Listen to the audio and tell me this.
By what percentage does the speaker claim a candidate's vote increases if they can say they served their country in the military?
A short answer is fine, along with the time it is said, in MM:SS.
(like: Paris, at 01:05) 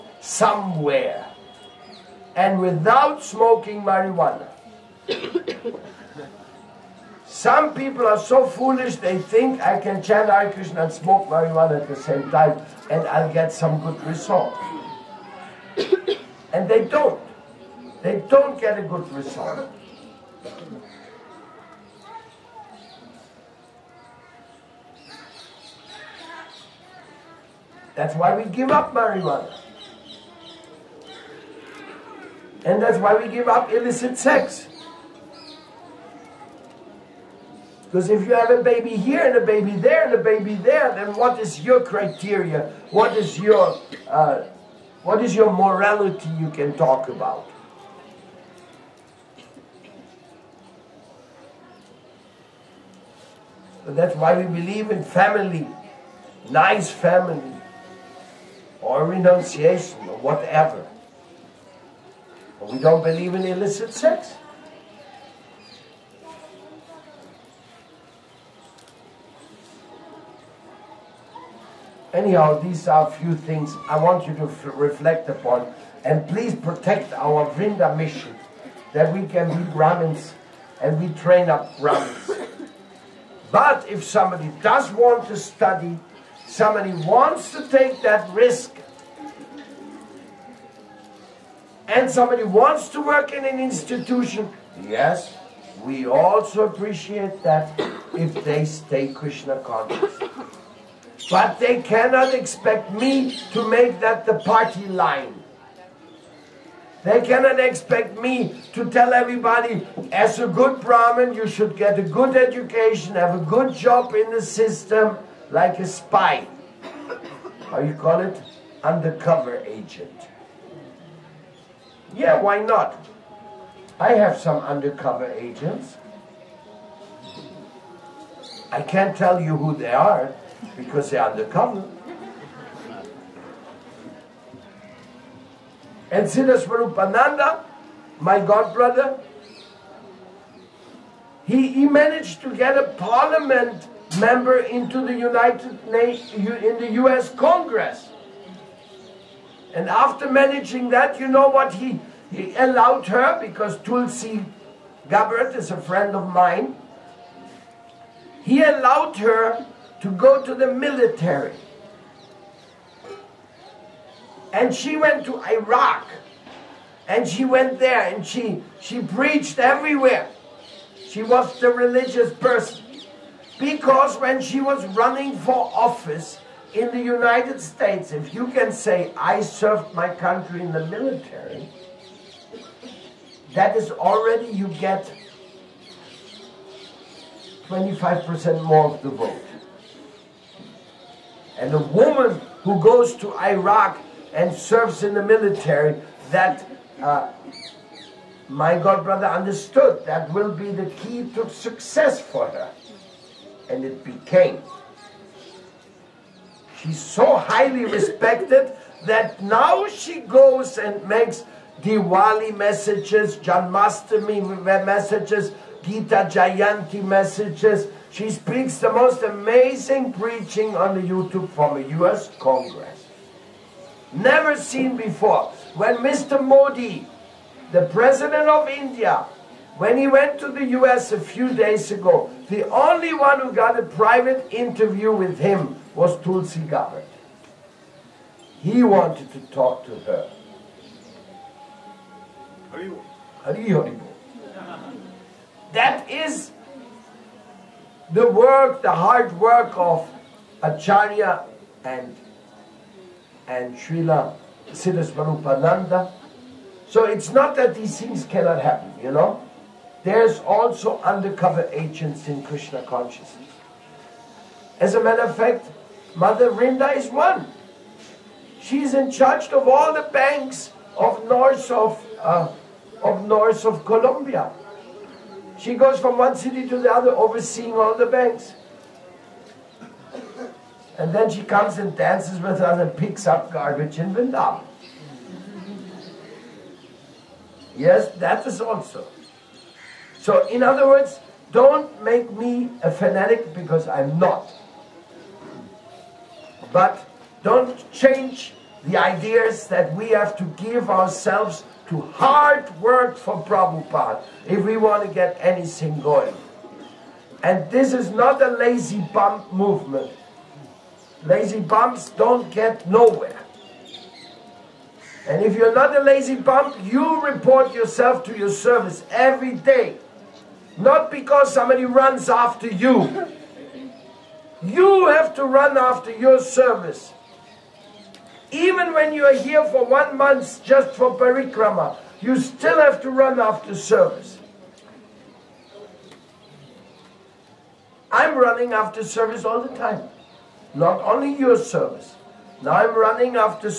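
25%, at 03:07.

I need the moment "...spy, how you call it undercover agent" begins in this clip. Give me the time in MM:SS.
01:55.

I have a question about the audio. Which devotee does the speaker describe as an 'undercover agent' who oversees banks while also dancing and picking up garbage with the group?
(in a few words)
Mother Rinda.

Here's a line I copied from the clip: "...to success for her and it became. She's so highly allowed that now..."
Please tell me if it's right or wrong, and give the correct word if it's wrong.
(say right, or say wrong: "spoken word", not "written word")
wrong: "respected", not "allowed".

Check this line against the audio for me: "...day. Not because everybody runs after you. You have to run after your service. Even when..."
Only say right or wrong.
wrong.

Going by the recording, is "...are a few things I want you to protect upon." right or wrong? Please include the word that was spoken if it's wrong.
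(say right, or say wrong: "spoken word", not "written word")
wrong: "reflect", not "protect".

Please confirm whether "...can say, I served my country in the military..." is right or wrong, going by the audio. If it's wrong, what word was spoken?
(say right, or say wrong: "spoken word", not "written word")
right.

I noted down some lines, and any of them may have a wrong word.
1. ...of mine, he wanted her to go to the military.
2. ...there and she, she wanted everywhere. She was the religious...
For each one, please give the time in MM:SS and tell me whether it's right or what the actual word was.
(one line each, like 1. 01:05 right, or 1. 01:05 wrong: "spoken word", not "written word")
1. 02:36 wrong: "allowed", not "wanted"
2. 02:47 wrong: "preached", not "wanted".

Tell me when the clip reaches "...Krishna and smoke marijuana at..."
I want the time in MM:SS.
00:10.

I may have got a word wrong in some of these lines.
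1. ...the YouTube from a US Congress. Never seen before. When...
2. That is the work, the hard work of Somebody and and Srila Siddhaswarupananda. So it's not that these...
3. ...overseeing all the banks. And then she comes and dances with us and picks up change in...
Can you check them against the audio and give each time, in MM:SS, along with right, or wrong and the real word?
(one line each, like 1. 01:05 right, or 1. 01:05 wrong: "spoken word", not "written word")
1. 03:40 right
2. 04:05 wrong: "Acharya", not "Somebody"
3. 04:37 wrong: "garbage", not "change".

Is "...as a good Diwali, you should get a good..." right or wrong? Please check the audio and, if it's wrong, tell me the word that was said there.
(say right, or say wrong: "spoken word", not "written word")
wrong: "Brahmin", not "Diwali".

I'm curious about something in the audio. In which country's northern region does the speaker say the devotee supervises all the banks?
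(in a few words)
Colombia.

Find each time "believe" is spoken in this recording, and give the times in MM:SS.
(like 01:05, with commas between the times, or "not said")
00:54, 01:03.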